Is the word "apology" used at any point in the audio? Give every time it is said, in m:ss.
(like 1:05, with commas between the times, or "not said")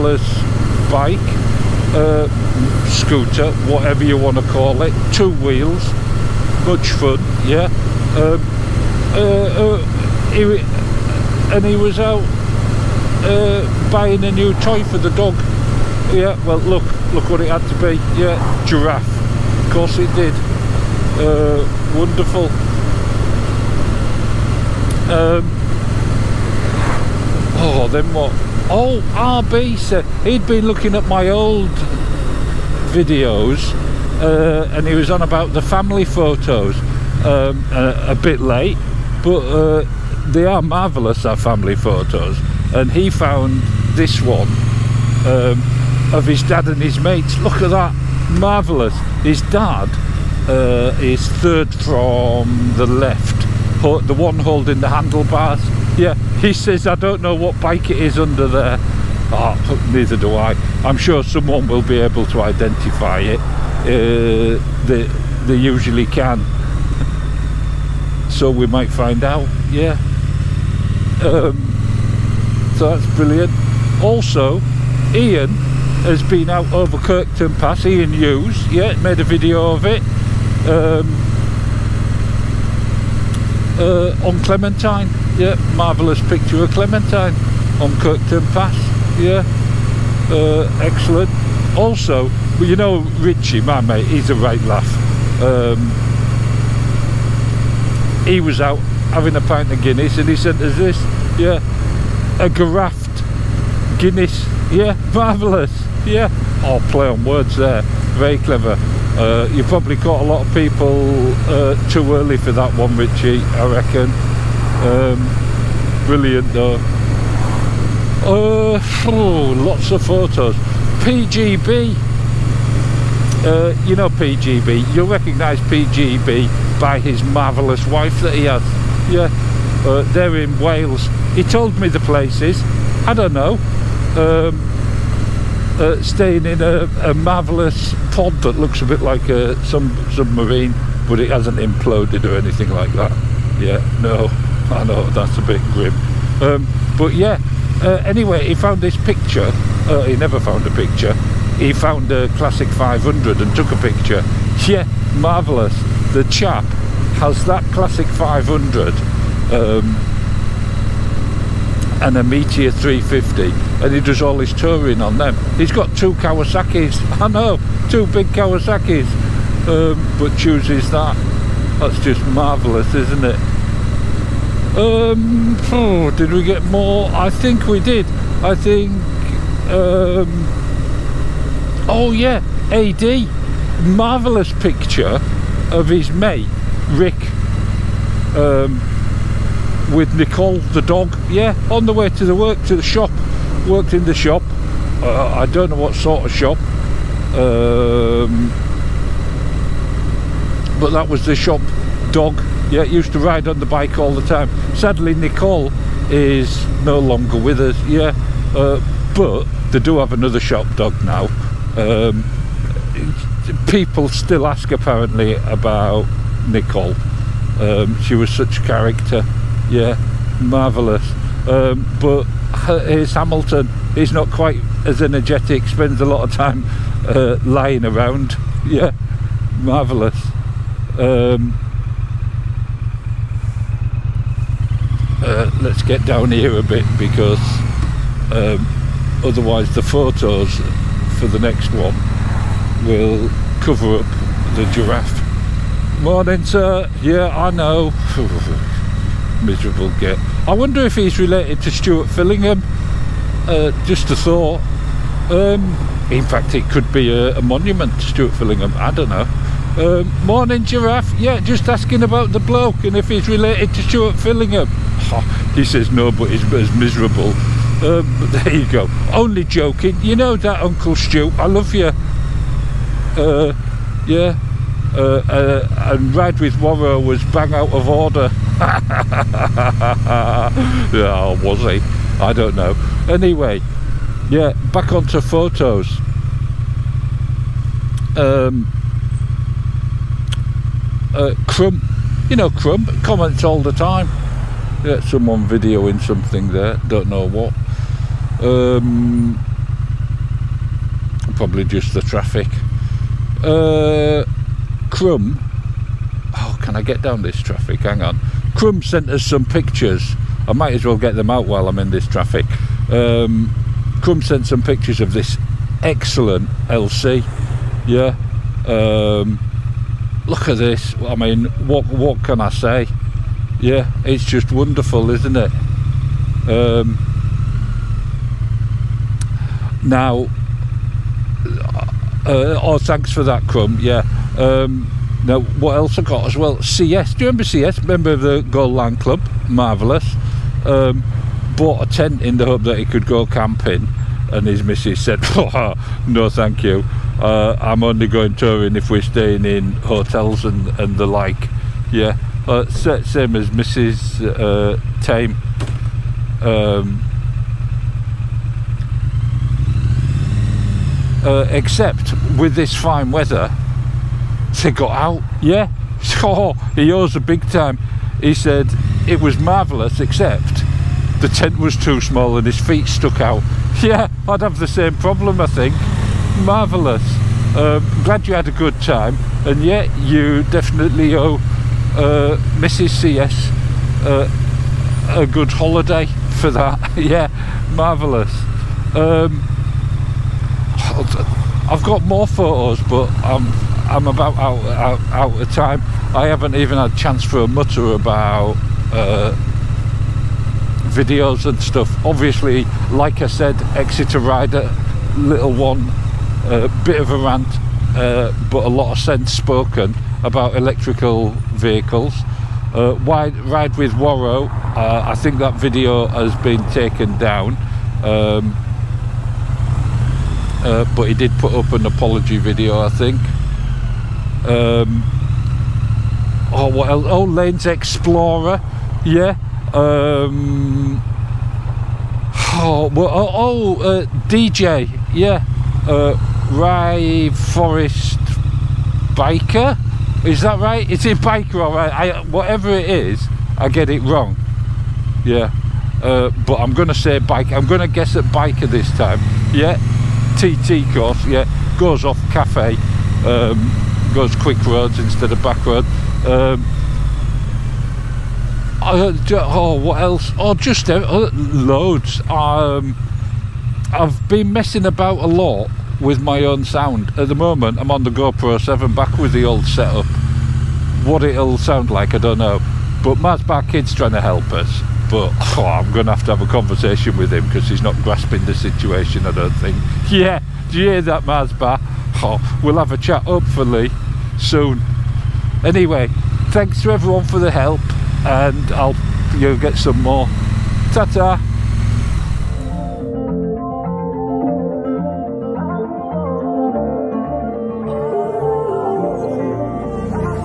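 7:01.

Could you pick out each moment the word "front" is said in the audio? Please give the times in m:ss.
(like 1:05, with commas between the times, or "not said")
not said.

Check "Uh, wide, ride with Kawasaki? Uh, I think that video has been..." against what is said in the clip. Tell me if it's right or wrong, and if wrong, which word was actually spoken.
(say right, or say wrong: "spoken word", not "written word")
wrong: "Wario", not "Kawasaki".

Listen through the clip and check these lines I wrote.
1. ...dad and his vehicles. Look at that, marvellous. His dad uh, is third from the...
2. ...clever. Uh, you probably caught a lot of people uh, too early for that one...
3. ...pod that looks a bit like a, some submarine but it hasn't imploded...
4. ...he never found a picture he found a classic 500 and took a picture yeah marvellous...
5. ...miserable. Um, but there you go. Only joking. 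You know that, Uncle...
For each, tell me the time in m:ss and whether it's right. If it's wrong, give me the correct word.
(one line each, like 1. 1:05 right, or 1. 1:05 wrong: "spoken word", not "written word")
1. 0:46 wrong: "mates", not "vehicles"
2. 1:48 right
3. 2:18 right
4. 2:30 right
5. 4:26 right.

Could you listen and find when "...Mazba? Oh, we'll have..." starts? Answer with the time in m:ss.
8:01.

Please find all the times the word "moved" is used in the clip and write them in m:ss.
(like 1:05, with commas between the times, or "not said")
not said.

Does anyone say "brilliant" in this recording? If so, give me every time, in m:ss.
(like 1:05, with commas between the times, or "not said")
1:13, 1:56.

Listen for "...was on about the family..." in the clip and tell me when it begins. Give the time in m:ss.
0:34.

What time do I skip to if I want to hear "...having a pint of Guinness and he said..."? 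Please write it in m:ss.
1:39.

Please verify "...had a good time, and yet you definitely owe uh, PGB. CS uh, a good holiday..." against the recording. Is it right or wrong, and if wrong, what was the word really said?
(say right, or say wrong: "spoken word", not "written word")
wrong: "Mrs", not "PGB".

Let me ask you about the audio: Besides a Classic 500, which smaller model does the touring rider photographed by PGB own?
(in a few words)
Meteor 350.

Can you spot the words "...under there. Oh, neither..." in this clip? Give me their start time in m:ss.
0:58.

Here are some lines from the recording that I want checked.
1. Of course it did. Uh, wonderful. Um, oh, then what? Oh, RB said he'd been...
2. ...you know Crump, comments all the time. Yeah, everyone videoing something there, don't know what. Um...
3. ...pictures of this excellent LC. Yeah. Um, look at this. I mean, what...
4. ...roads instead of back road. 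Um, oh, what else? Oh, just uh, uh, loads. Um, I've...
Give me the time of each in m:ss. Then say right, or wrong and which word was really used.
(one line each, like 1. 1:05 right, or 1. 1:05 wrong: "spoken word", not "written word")
1. 0:19 right
2. 4:52 wrong: "someone", not "everyone"
3. 5:14 right
4. 7:34 right.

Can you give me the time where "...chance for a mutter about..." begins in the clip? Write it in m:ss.
6:36.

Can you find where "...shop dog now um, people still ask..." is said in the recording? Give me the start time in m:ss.
3:30.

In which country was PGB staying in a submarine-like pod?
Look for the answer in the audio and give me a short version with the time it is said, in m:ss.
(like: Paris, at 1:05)
Wales, at 2:10.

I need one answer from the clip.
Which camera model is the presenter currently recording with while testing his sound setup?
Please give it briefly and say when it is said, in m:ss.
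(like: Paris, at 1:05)
GoPro 7, at 7:48.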